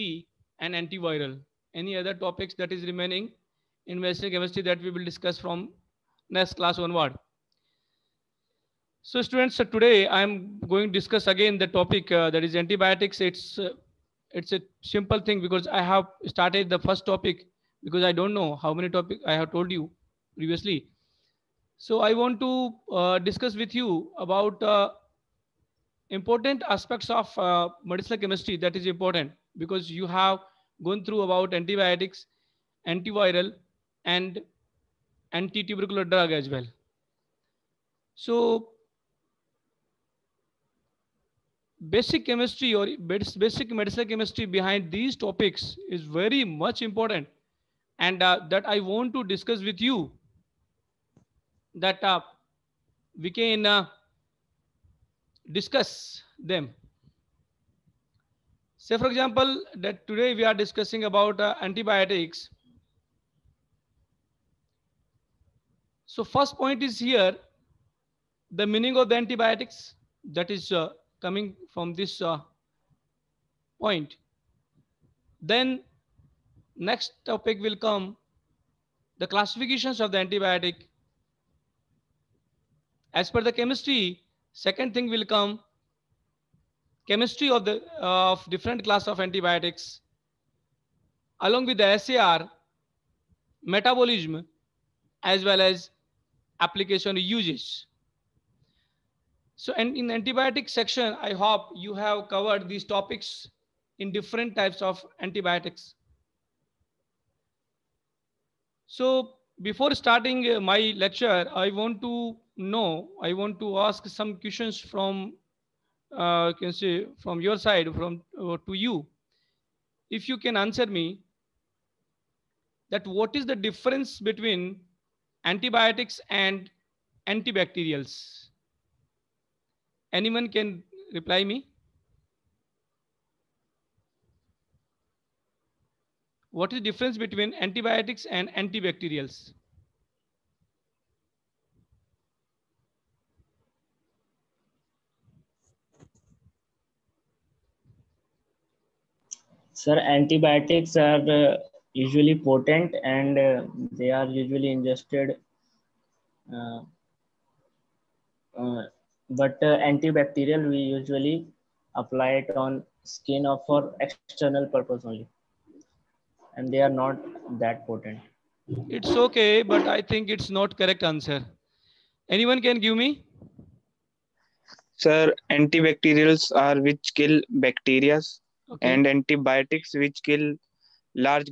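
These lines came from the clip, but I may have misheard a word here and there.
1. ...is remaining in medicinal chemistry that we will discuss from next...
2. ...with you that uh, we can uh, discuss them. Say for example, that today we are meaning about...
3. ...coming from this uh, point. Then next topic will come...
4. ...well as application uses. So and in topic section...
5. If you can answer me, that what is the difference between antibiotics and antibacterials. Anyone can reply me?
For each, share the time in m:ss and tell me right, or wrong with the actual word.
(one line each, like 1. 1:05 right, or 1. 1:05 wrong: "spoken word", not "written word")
1. 0:02 right
2. 0:49 wrong: "discussing", not "meaning"
3. 1:11 right
4. 1:35 wrong: "antibiotic", not "topic"
5. 2:00 right.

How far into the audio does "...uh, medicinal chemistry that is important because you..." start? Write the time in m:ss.
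0:27.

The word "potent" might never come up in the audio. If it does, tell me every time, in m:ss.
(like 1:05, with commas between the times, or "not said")
2:32, 2:47.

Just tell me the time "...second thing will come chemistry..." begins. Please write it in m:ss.
1:24.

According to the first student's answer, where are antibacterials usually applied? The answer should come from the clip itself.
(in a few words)
On skin.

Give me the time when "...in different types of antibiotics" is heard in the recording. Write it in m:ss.
1:43.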